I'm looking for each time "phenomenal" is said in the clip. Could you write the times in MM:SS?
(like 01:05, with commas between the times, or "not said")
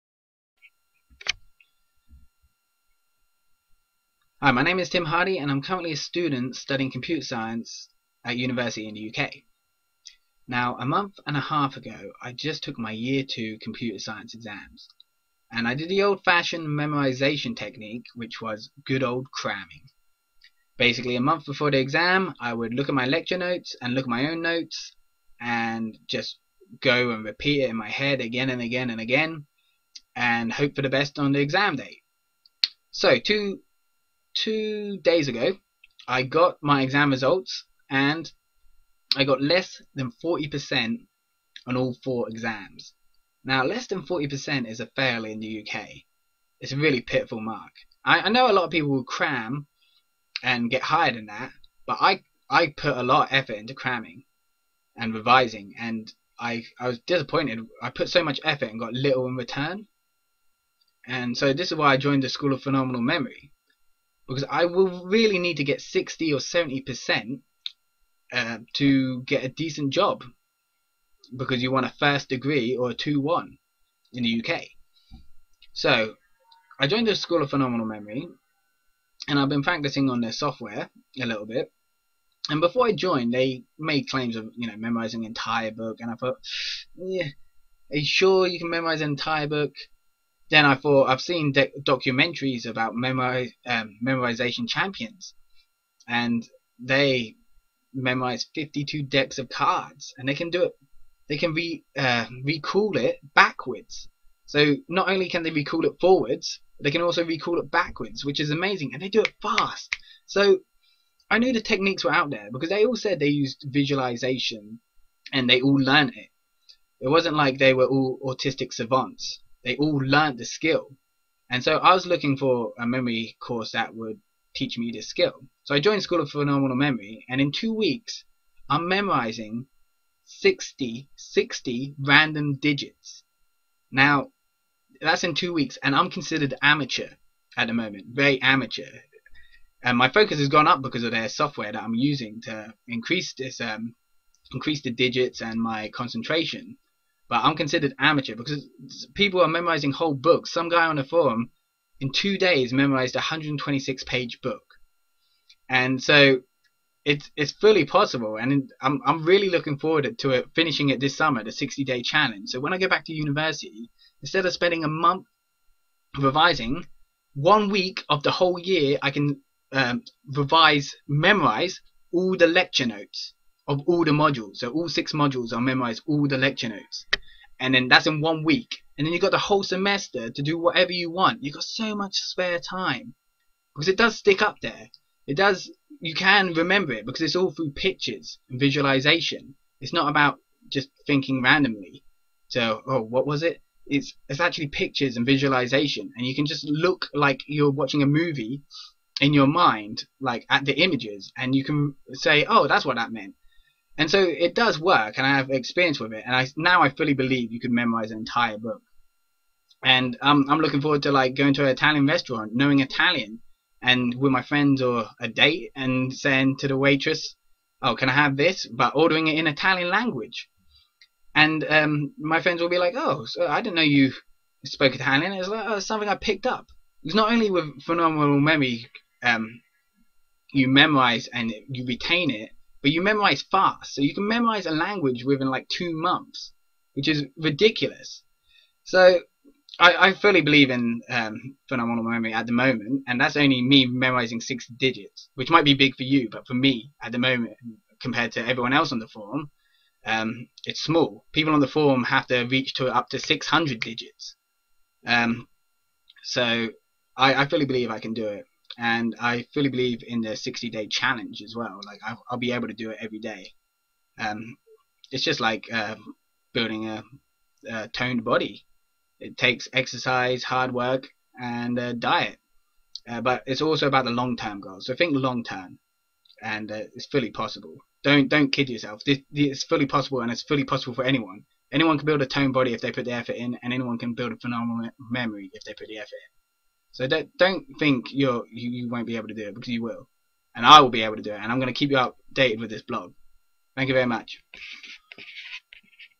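01:02, 01:17, 02:06, 03:47, 04:01, 04:44.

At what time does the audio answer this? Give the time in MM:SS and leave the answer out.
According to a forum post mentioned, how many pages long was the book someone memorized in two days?
02:33.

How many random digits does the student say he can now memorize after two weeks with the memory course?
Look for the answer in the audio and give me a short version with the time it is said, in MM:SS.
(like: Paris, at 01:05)
60, at 02:11.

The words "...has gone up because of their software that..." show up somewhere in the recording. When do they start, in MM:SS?
02:20.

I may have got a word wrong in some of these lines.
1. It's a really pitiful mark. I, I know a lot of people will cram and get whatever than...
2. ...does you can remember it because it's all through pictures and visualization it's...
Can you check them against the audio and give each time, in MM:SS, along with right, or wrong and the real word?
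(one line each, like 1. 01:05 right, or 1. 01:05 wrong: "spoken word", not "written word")
1. 00:46 wrong: "higher", not "whatever"
2. 03:05 right.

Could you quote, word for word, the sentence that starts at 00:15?
And I did the old-fashioned memorization technique, which was good old cramming.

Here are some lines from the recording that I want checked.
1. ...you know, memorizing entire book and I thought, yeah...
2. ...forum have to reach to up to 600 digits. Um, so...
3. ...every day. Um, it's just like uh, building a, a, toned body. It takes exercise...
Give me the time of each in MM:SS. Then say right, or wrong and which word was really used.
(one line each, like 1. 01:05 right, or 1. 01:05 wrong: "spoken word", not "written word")
1. 01:24 right
2. 04:11 right
3. 04:22 right.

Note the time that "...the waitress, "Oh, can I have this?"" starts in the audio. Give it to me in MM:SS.
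03:36.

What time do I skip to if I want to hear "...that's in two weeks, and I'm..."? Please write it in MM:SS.
02:15.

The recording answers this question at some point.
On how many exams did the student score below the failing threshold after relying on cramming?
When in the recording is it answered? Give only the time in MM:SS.
00:42.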